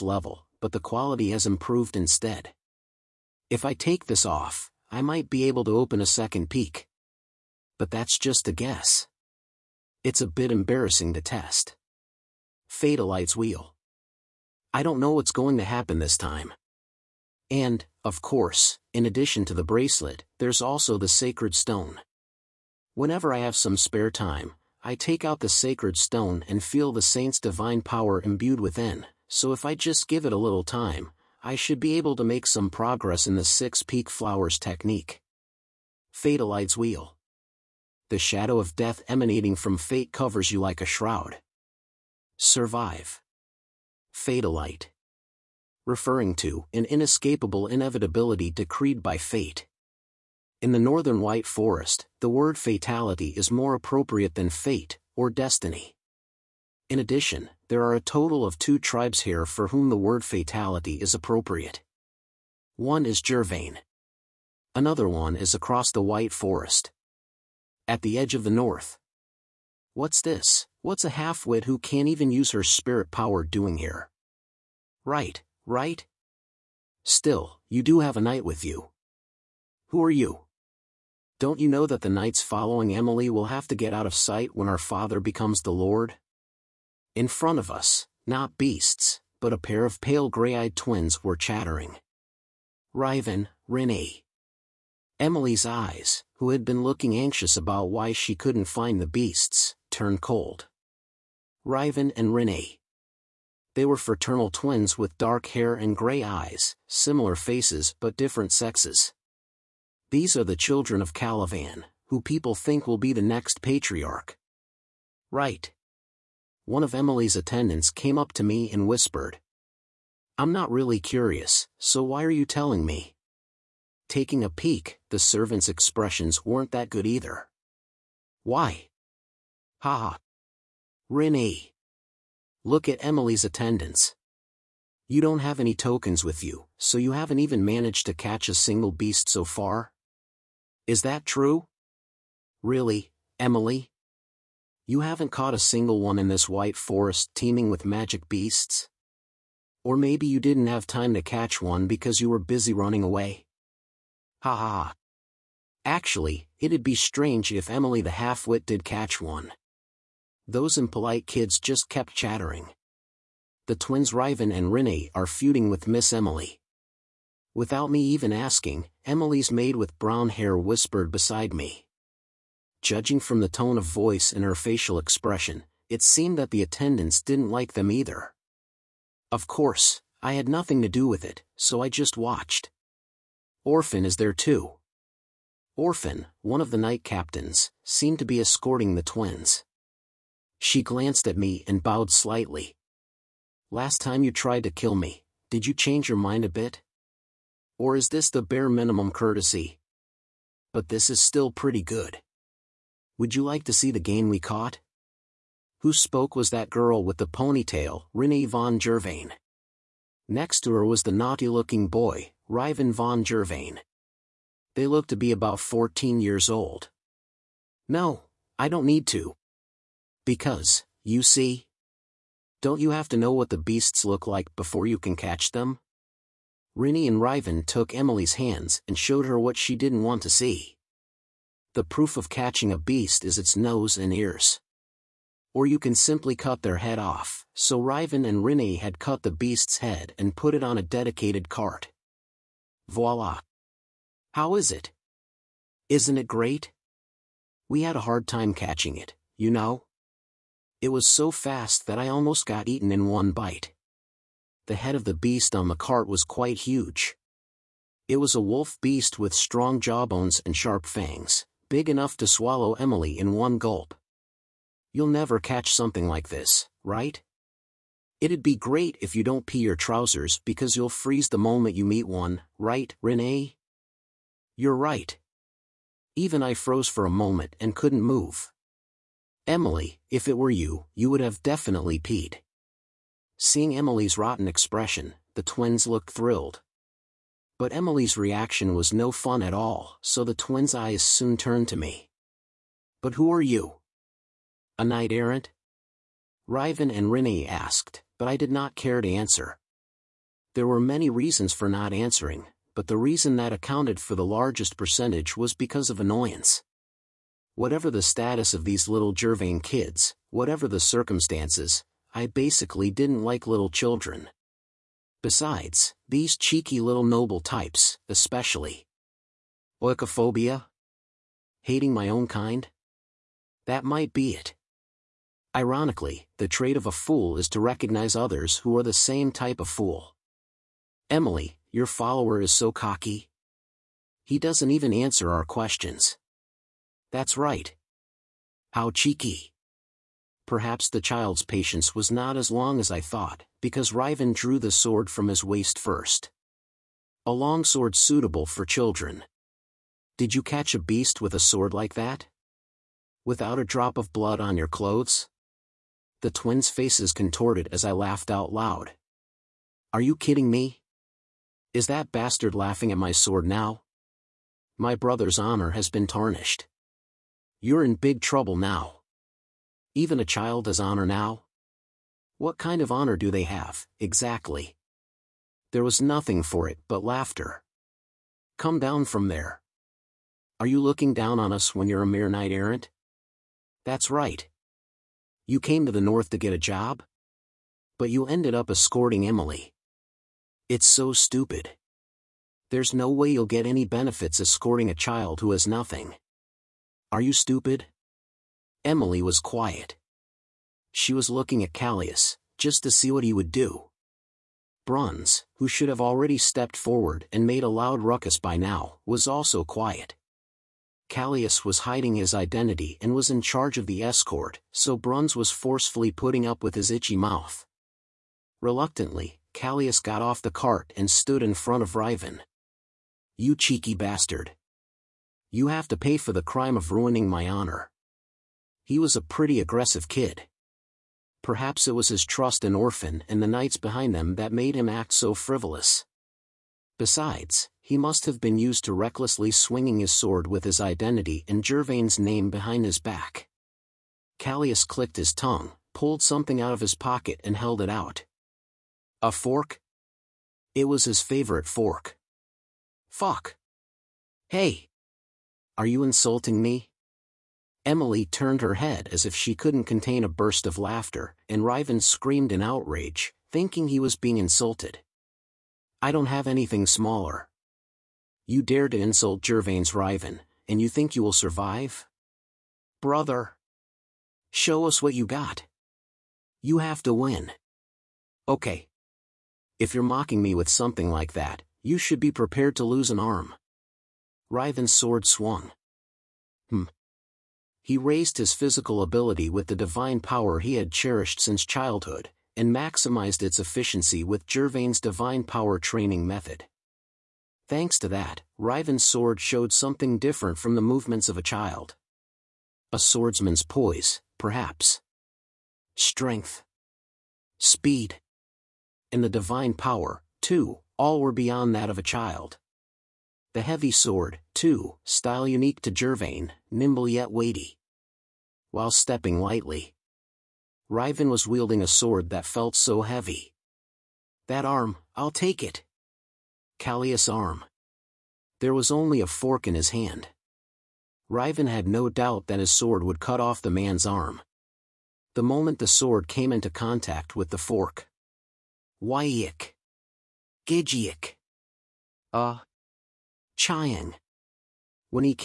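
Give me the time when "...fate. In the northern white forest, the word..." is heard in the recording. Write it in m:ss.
0:49.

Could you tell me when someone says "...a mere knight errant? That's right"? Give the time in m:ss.
6:22.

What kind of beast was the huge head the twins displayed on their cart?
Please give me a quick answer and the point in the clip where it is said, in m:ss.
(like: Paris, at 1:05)
wolf beast, at 4:18.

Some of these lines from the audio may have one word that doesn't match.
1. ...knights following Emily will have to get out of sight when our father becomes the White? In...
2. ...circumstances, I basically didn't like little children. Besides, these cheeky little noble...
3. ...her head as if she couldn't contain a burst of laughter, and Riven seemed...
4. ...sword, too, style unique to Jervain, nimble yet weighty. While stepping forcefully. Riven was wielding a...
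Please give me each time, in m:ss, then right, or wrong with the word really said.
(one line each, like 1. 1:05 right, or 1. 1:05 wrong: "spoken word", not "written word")
1. 1:22 wrong: "Lord", not "White"
2. 5:10 right
3. 7:38 wrong: "screamed", not "seemed"
4. 8:33 wrong: "lightly", not "forcefully".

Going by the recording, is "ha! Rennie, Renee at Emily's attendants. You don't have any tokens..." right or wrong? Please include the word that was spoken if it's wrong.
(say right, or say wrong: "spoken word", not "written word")
wrong: "Look", not "Renee".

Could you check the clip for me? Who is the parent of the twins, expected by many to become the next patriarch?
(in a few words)
Calavan.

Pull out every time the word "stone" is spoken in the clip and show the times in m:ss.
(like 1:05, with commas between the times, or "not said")
0:21, 0:25.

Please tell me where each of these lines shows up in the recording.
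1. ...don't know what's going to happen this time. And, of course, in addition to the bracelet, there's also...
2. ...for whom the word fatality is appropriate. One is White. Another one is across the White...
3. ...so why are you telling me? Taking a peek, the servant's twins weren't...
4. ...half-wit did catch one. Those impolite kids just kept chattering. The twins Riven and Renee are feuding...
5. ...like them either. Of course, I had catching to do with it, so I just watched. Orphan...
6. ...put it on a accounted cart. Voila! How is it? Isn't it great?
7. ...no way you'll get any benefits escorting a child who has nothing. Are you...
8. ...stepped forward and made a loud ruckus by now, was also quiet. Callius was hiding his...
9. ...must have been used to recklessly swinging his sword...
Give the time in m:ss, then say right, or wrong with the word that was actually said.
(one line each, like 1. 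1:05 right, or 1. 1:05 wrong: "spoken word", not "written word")
1. 0:14 right
2. 0:59 wrong: "Jervain", not "White"
3. 2:01 wrong: "expressions", not "twins"
4. 2:38 right
5. 2:57 wrong: "nothing", not "catching"
6. 4:00 wrong: "dedicated", not "accounted"
7. 6:32 right
8. 6:46 right
9. 7:17 right.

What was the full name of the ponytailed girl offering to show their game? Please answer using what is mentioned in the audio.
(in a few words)
Renee von Jervain.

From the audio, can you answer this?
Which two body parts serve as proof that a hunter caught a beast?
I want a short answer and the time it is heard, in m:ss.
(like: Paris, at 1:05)
nose and ears, at 3:53.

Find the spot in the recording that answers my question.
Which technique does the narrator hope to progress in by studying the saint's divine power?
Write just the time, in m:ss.
0:33.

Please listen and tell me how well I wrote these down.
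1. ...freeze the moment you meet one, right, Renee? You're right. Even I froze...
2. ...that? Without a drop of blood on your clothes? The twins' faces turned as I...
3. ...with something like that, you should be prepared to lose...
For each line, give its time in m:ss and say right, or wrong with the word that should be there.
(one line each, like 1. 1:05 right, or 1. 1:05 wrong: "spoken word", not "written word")
1. 4:30 right
2. 5:51 wrong: "contorted", not "turned"
3. 8:00 right.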